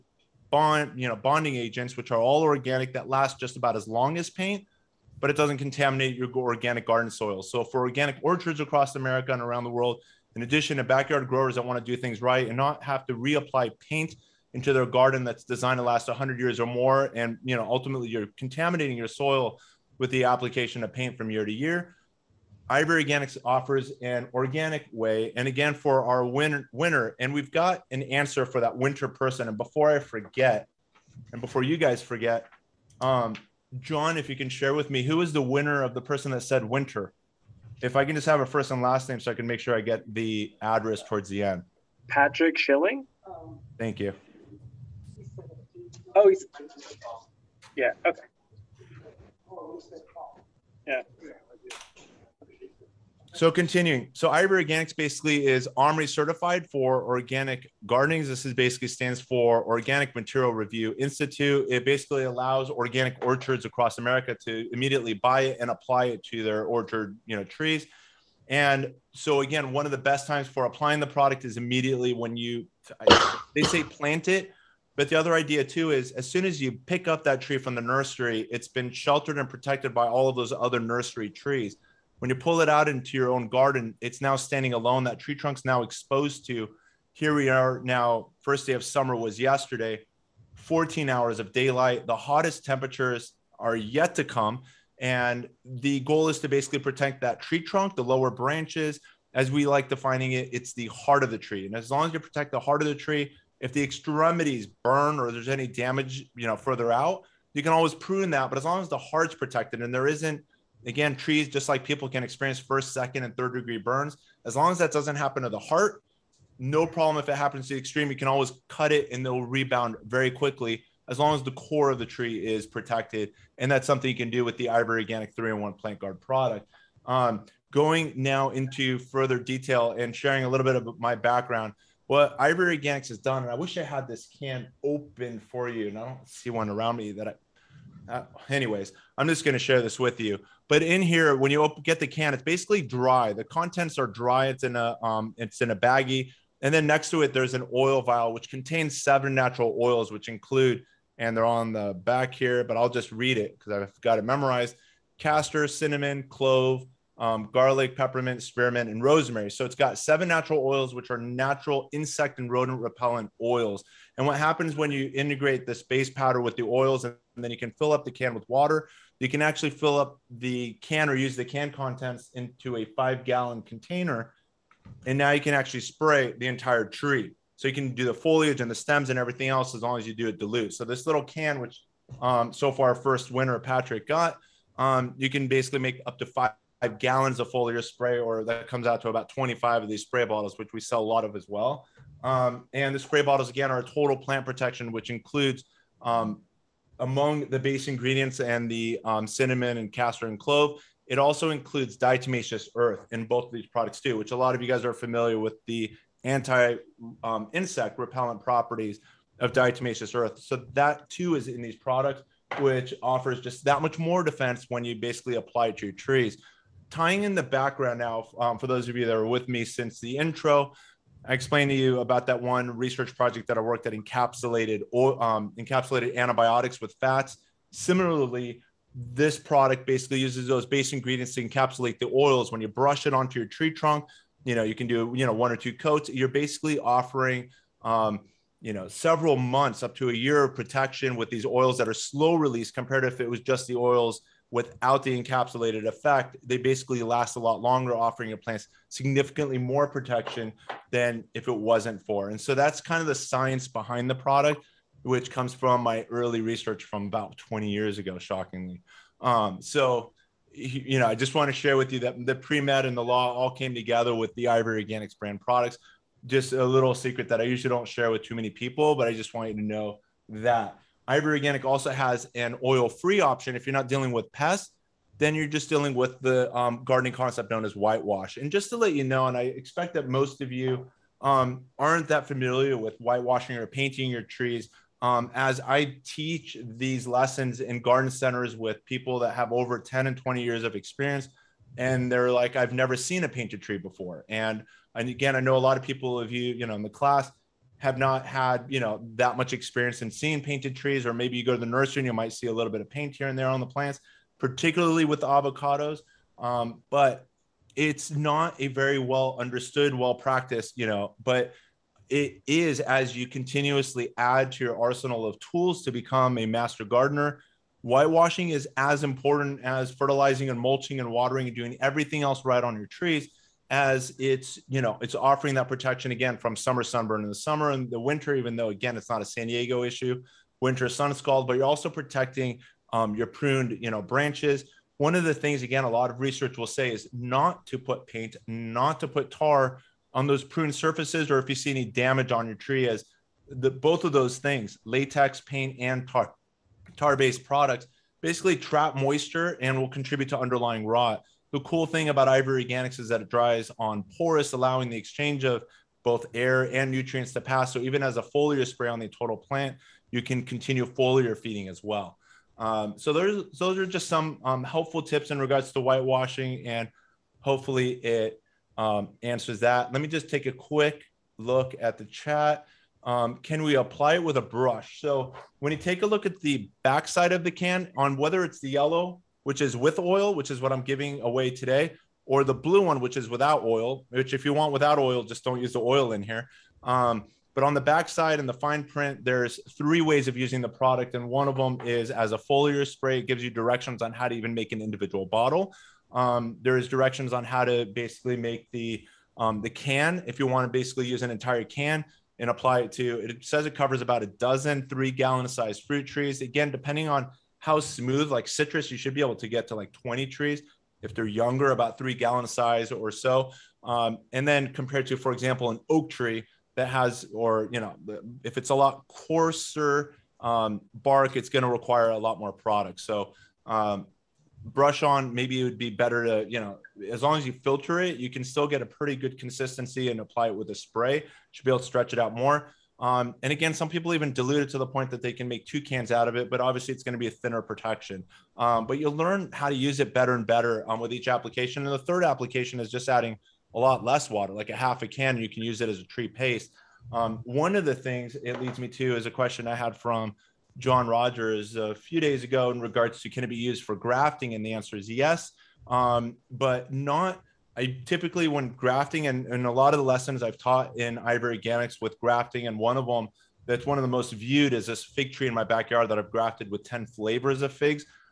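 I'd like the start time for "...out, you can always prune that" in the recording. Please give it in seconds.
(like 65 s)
106 s.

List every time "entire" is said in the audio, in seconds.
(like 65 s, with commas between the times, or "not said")
176 s, 401 s.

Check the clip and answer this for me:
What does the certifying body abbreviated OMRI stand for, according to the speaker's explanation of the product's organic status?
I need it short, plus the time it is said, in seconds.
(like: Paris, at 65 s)
Organic Material Review Institute, at 59 s.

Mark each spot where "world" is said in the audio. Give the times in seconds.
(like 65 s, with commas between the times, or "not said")
9 s.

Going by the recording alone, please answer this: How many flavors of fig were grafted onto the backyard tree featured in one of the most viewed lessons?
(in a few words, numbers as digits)
10.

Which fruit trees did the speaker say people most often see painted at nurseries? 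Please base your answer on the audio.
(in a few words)
avocados.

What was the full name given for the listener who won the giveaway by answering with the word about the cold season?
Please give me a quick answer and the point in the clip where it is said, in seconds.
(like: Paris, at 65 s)
Patrick Schilling, at 42 s.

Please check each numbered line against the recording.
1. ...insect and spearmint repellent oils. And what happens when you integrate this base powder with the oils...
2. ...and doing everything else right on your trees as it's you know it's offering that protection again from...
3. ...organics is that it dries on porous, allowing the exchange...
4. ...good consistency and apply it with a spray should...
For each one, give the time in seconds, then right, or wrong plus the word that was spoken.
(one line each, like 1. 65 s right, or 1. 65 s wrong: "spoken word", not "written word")
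1. 161 s wrong: "rodent", not "spearmint"
2. 321 s right
3. 352 s right
4. 429 s right.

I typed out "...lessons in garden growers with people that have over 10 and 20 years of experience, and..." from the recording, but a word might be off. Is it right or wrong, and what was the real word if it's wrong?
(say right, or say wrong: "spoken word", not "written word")
wrong: "centers", not "growers".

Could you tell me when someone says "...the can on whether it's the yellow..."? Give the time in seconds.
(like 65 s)
377 s.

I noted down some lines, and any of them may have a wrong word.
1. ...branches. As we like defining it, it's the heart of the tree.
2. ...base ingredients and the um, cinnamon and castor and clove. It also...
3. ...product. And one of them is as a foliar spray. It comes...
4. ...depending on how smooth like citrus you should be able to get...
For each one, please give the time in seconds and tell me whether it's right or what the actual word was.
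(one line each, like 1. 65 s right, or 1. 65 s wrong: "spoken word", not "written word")
1. 98 s right
2. 197 s right
3. 390 s wrong: "gives", not "comes"
4. 406 s right.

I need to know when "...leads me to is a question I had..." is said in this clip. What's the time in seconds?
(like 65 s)
448 s.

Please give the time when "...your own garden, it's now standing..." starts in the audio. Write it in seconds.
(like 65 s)
83 s.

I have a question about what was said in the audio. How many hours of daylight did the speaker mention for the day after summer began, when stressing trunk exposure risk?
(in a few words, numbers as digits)
14.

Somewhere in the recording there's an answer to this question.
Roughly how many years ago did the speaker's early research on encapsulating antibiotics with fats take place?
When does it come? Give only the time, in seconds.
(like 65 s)
257 s.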